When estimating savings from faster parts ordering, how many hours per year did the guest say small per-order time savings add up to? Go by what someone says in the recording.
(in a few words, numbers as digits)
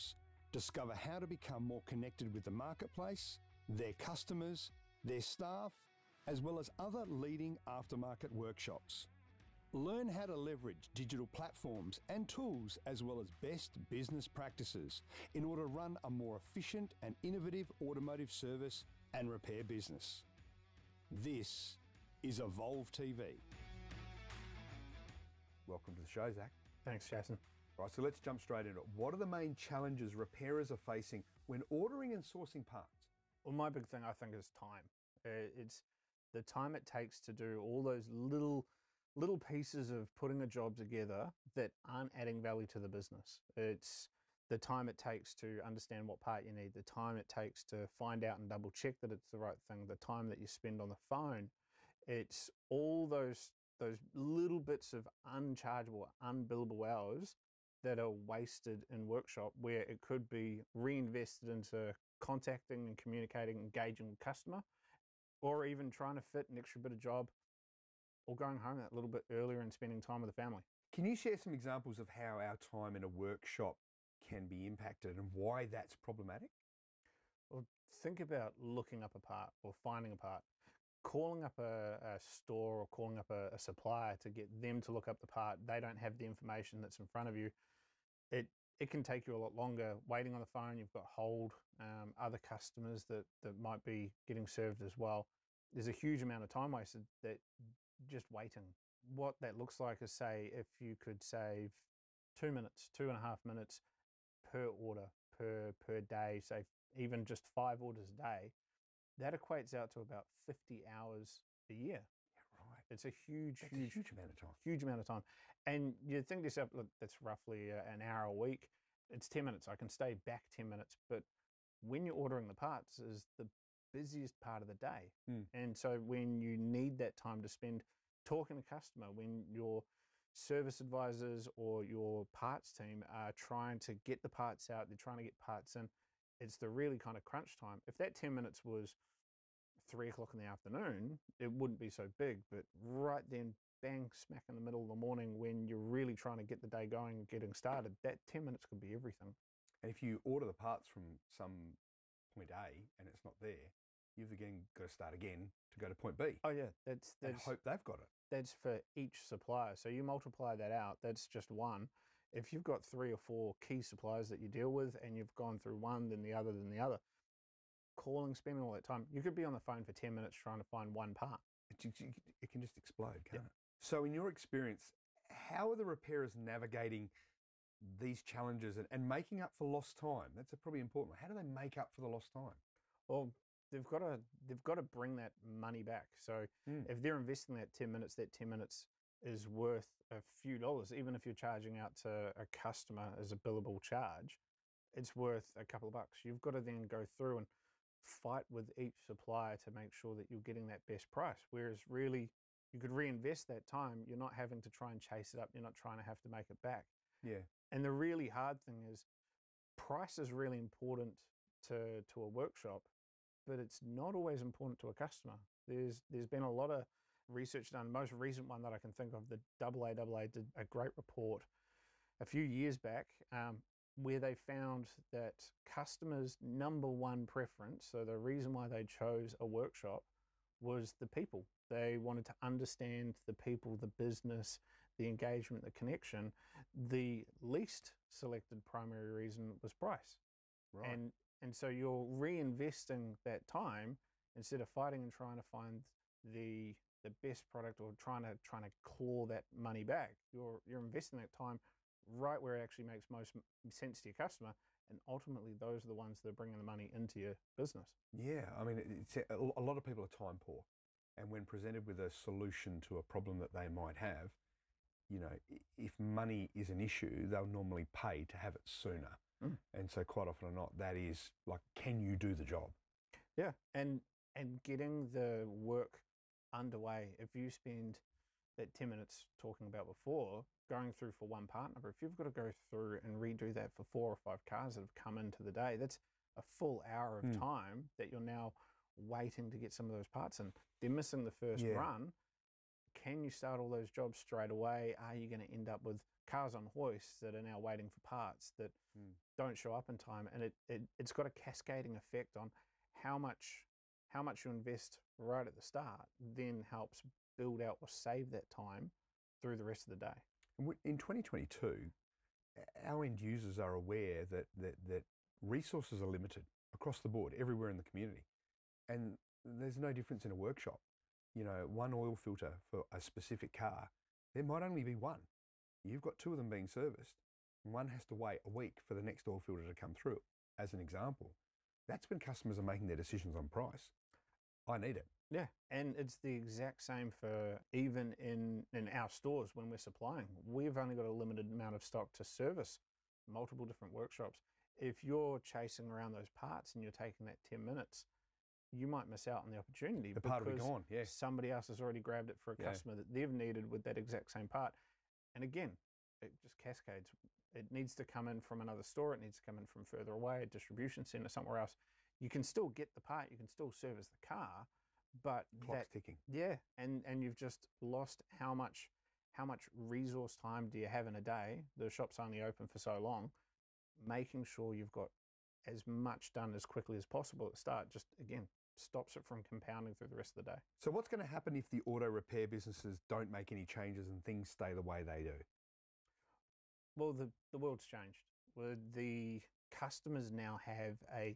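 50 hours.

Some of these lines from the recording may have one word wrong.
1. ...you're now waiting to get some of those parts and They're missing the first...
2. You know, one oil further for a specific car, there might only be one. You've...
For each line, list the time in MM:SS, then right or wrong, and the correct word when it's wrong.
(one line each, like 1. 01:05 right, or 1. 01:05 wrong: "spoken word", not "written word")
1. 04:48 right
2. 05:21 wrong: "filter", not "further".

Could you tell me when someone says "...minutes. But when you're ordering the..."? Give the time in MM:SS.
02:00.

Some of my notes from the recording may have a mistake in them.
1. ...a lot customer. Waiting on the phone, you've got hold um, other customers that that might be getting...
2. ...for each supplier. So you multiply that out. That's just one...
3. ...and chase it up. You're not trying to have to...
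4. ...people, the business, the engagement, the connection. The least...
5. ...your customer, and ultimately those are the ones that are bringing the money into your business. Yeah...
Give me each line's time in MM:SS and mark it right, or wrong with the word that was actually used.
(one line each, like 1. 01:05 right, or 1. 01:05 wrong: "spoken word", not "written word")
1. 01:29 wrong: "longer", not "customer"
2. 02:38 right
3. 03:24 right
4. 03:53 right
5. 04:14 right.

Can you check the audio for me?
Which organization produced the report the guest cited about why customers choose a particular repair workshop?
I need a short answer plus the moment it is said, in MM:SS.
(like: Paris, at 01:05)
AAA, at 03:39.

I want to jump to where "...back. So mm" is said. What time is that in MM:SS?
03:05.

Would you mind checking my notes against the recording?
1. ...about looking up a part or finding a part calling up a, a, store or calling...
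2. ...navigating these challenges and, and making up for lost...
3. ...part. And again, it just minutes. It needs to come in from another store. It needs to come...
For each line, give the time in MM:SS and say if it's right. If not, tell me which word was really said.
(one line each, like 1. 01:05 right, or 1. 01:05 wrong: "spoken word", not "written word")
1. 01:18 right
2. 02:56 right
3. 05:54 wrong: "cascades", not "minutes".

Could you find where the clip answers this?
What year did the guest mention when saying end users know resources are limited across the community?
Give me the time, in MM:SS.
05:10.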